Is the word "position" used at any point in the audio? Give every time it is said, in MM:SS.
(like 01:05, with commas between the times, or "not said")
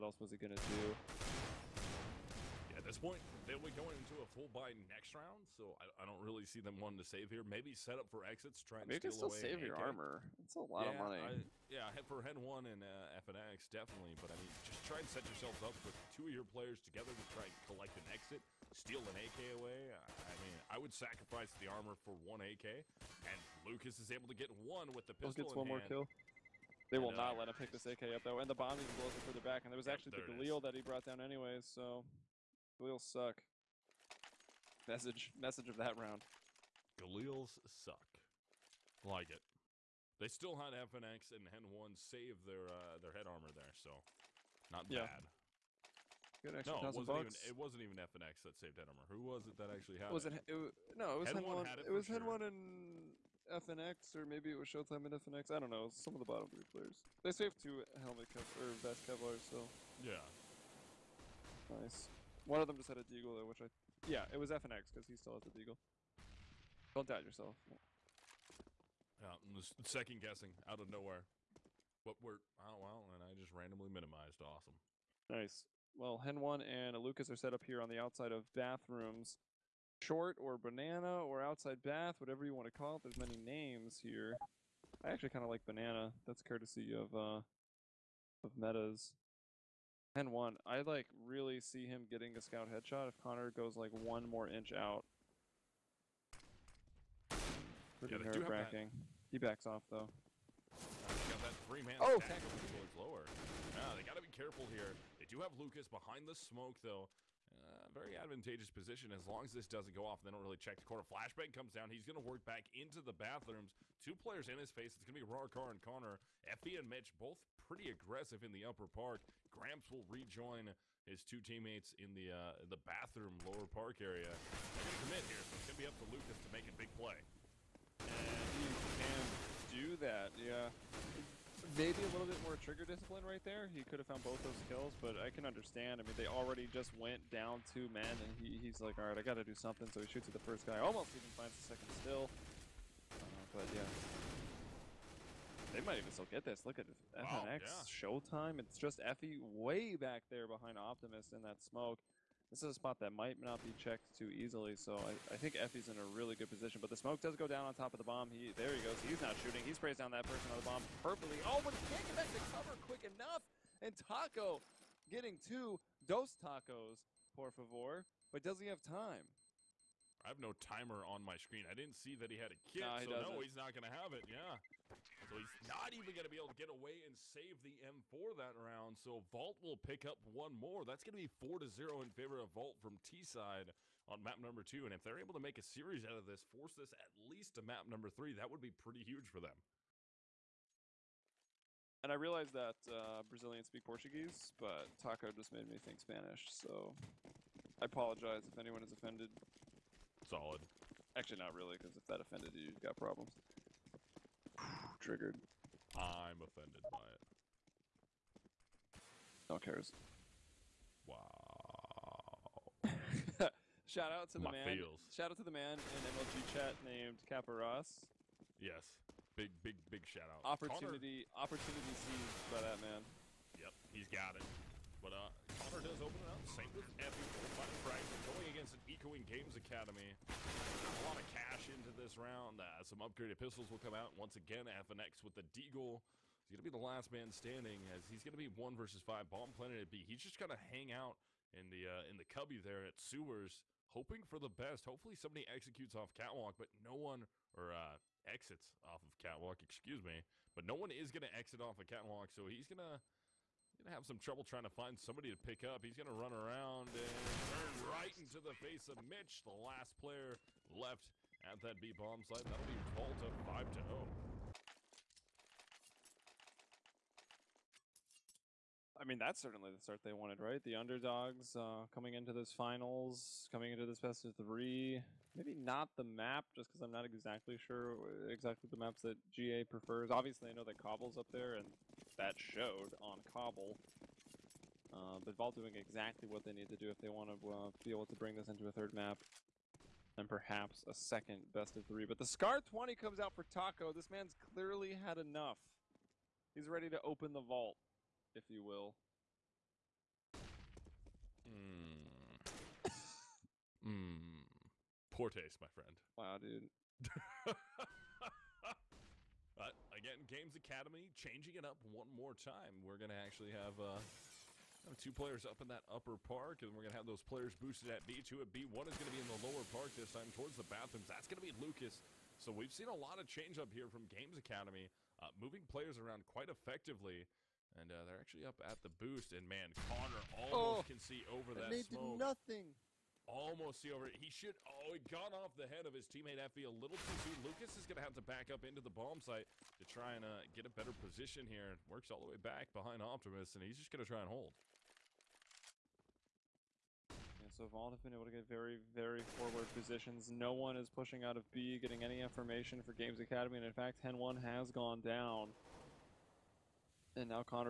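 01:48, 02:36, 05:40, 05:49.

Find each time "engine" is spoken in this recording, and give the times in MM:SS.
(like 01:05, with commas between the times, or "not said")
not said.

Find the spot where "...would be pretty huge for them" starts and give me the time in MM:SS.
03:08.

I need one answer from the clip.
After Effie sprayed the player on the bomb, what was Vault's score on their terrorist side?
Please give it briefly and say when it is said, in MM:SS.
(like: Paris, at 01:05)
4 to 0, at 03:01.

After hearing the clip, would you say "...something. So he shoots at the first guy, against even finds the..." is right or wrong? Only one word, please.
wrong.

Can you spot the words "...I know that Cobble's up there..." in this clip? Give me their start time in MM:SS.
04:40.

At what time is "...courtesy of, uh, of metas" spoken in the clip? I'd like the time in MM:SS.
01:26.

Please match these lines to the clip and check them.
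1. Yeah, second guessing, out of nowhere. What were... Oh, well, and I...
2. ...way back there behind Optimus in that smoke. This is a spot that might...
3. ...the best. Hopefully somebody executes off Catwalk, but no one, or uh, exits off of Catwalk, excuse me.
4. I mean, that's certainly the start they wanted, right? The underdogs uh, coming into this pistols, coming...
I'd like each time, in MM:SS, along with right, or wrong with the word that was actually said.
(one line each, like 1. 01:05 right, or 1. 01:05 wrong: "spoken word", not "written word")
1. 01:09 right
2. 02:29 right
3. 04:04 right
4. 04:29 wrong: "finals", not "pistols".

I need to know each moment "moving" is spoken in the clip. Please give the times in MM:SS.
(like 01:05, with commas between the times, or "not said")
05:25.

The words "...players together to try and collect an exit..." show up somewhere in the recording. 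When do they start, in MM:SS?
00:16.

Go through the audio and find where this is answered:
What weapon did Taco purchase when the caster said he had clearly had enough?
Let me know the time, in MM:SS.
04:52.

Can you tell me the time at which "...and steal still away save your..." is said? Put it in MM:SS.
00:08.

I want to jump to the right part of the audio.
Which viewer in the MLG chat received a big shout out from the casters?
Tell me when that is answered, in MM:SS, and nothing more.
03:37.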